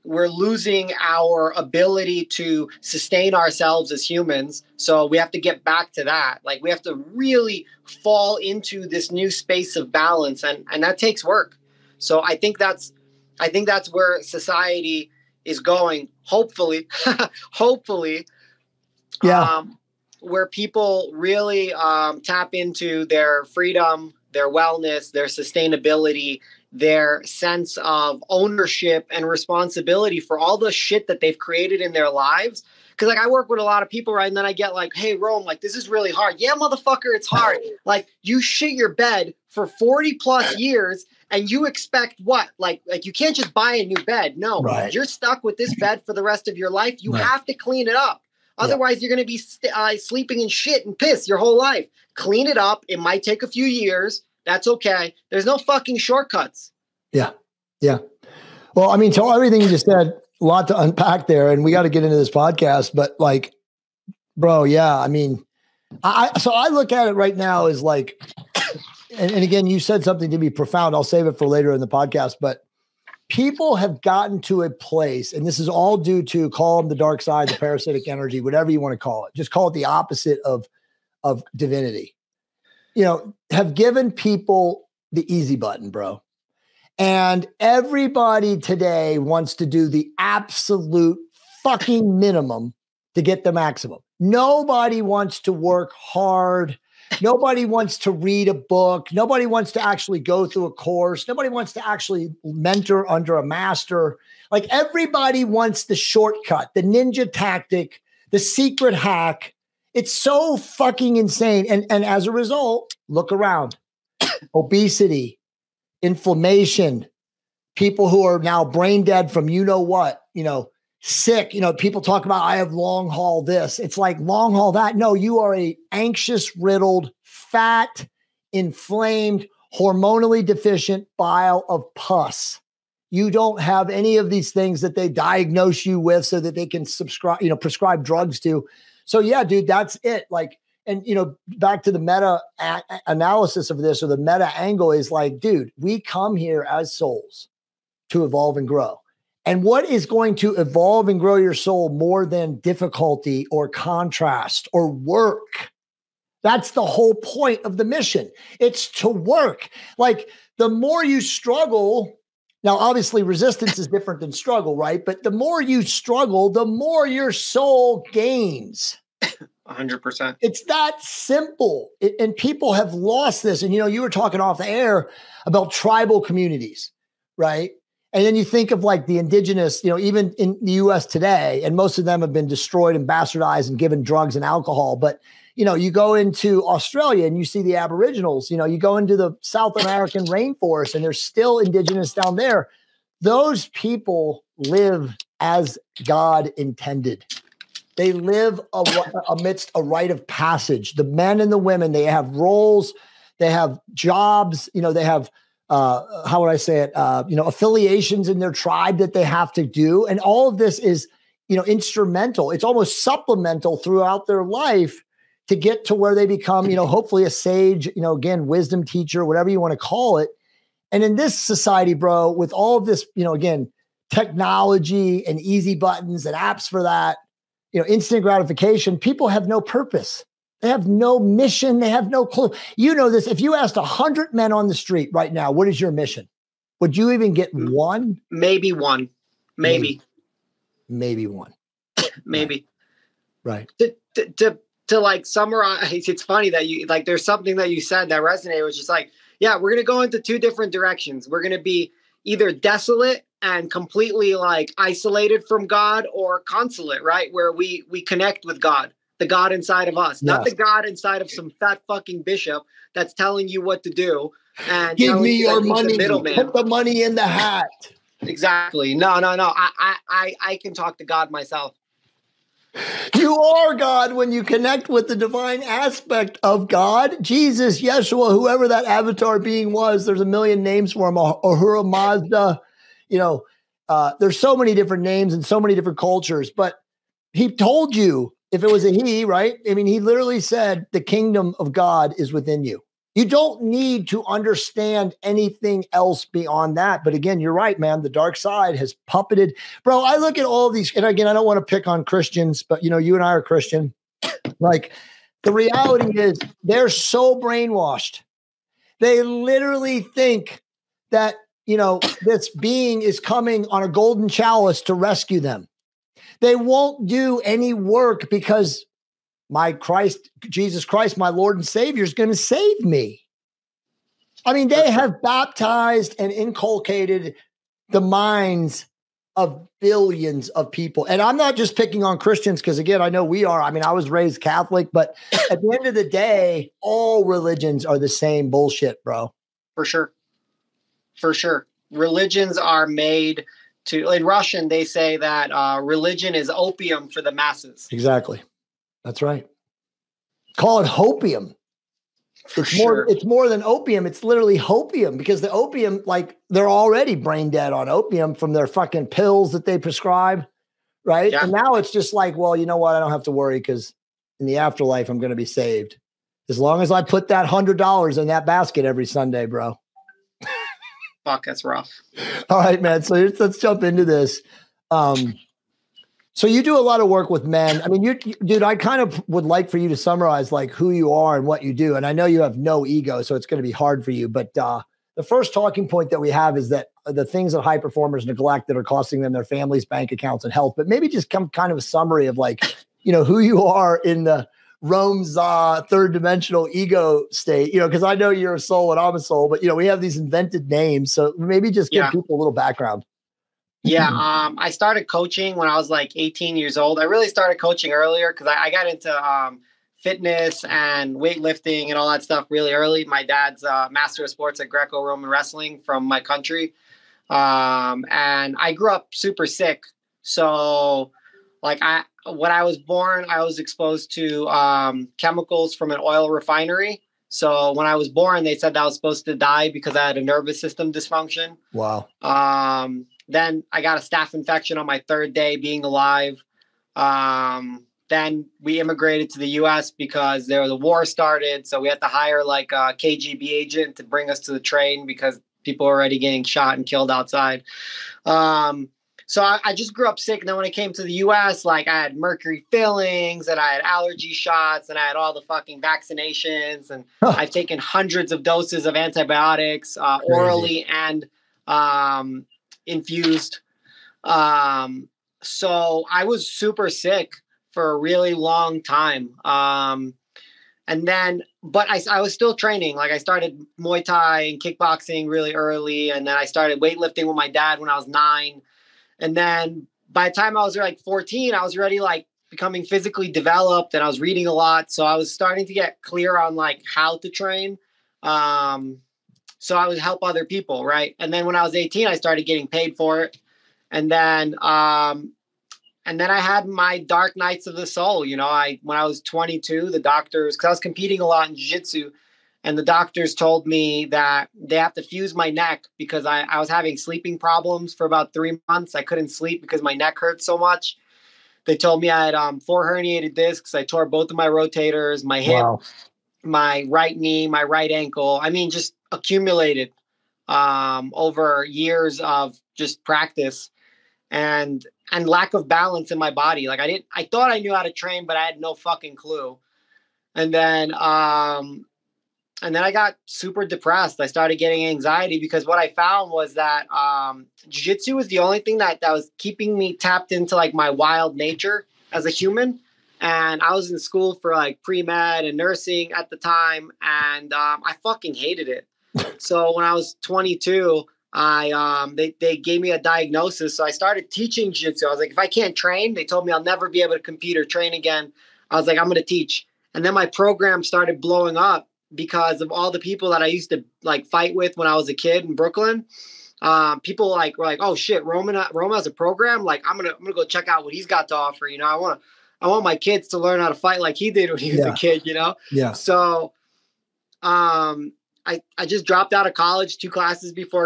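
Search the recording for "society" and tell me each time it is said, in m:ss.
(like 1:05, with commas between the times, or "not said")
0:14, 3:41.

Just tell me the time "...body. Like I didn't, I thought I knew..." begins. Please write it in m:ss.
8:46.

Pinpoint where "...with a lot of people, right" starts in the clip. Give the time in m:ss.
0:33.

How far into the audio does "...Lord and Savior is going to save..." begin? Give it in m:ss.
5:21.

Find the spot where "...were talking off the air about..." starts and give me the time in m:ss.
2:54.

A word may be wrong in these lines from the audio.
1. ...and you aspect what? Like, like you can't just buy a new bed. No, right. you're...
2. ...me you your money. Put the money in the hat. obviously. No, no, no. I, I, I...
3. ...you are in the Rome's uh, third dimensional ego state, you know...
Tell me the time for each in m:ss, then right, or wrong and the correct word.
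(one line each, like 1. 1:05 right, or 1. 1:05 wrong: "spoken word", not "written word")
1. 0:41 wrong: "expect", not "aspect"
2. 4:25 wrong: "exactly", not "obviously"
3. 6:33 right.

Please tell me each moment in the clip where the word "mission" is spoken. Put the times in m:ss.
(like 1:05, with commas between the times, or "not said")
2:37, 3:51, 3:55.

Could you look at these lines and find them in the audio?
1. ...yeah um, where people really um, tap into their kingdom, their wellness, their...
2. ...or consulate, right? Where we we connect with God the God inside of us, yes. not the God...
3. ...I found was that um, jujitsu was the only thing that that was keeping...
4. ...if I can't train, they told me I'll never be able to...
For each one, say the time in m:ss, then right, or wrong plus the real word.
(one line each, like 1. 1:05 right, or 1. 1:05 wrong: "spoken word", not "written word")
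1. 0:19 wrong: "freedom", not "kingdom"
2. 4:16 right
3. 8:55 right
4. 9:15 right.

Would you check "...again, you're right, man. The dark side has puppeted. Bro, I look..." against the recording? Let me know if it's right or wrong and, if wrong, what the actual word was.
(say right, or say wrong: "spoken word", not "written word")
right.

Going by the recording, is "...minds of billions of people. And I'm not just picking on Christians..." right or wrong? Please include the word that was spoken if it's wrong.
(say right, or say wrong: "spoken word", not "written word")
right.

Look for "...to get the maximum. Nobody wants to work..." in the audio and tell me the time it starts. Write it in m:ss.
1:33.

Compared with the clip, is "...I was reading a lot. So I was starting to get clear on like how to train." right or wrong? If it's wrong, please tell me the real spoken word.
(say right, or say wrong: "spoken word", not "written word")
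right.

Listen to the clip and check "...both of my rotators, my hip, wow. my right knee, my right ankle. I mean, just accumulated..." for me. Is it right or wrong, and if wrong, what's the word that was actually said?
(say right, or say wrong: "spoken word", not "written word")
right.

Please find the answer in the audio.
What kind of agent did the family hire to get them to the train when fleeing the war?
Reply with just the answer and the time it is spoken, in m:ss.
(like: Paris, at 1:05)
KGB agent, at 7:22.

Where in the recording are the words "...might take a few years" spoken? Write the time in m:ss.
0:52.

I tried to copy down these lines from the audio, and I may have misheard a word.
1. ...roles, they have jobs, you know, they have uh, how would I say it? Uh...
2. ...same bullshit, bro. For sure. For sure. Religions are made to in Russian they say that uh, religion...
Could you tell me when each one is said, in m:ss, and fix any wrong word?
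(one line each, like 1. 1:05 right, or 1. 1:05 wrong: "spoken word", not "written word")
1. 3:22 right
2. 5:38 right.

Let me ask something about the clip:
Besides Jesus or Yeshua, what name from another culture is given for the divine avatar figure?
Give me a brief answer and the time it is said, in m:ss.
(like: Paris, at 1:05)
Ahura Mazda, at 4:41.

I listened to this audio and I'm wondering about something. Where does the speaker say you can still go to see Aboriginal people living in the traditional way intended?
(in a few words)
Australia.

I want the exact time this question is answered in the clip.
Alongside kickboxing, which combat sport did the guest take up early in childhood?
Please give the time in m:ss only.
7:53.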